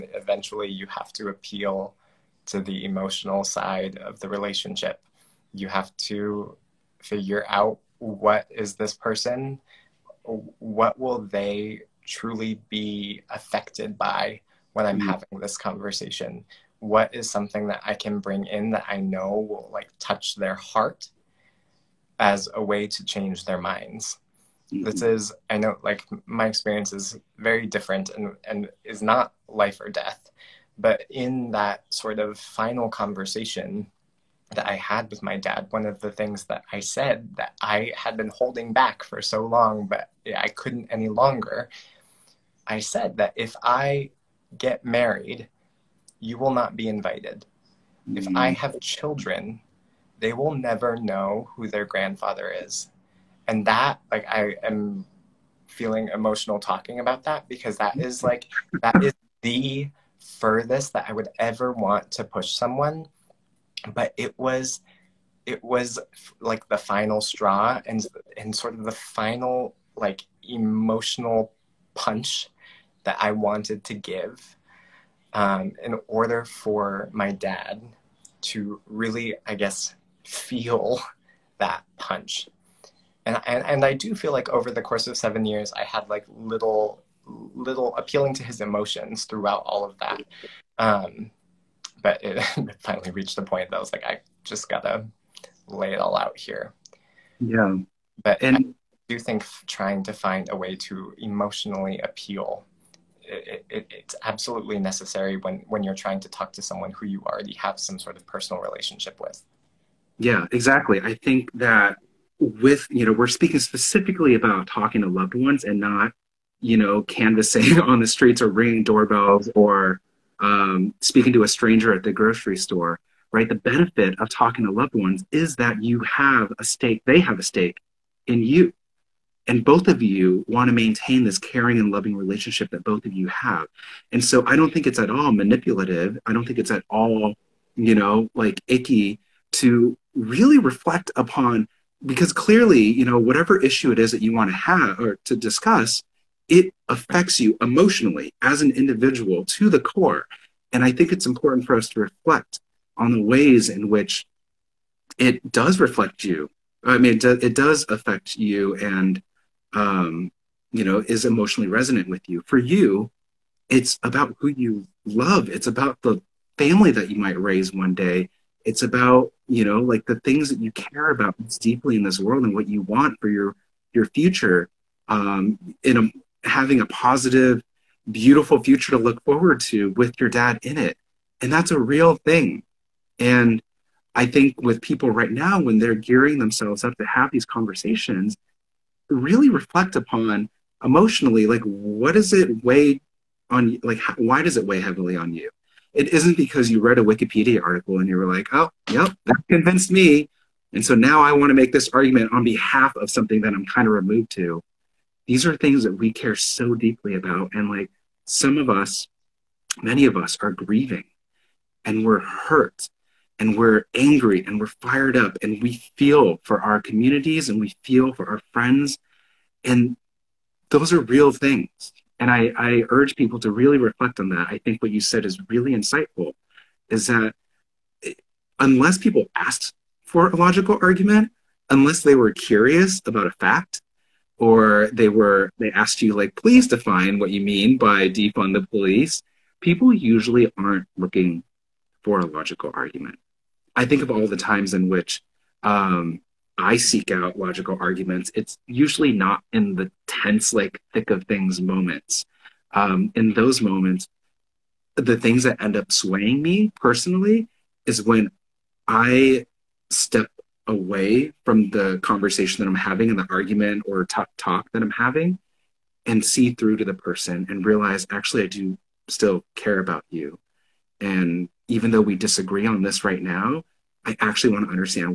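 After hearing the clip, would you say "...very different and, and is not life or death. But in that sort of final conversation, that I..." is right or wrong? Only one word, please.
right.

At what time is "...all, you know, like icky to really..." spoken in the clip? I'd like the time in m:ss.
2:16.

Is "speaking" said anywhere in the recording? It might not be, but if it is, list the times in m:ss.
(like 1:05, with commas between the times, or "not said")
1:53, 2:01.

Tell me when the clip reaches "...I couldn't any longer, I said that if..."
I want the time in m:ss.
0:40.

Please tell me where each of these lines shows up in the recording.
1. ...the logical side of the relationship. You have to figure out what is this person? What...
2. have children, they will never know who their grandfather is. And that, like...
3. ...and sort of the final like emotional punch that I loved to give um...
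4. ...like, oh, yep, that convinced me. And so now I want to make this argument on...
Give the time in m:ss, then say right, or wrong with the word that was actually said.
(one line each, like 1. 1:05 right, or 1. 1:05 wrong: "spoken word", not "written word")
1. 0:02 wrong: "emotional", not "logical"
2. 0:48 right
3. 1:08 wrong: "wanted", not "loved"
4. 3:18 right.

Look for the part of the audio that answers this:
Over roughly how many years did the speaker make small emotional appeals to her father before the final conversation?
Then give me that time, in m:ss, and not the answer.
1:25.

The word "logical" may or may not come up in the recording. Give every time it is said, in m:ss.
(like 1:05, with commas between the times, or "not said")
3:50, 4:02, 4:07.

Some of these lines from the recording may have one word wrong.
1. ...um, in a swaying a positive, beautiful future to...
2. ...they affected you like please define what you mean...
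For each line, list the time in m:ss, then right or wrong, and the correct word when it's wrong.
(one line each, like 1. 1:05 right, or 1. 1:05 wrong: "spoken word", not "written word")
1. 2:55 wrong: "having", not "swaying"
2. 3:55 wrong: "asked", not "affected".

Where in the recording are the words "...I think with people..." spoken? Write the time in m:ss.
3:04.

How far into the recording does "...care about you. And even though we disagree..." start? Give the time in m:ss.
4:29.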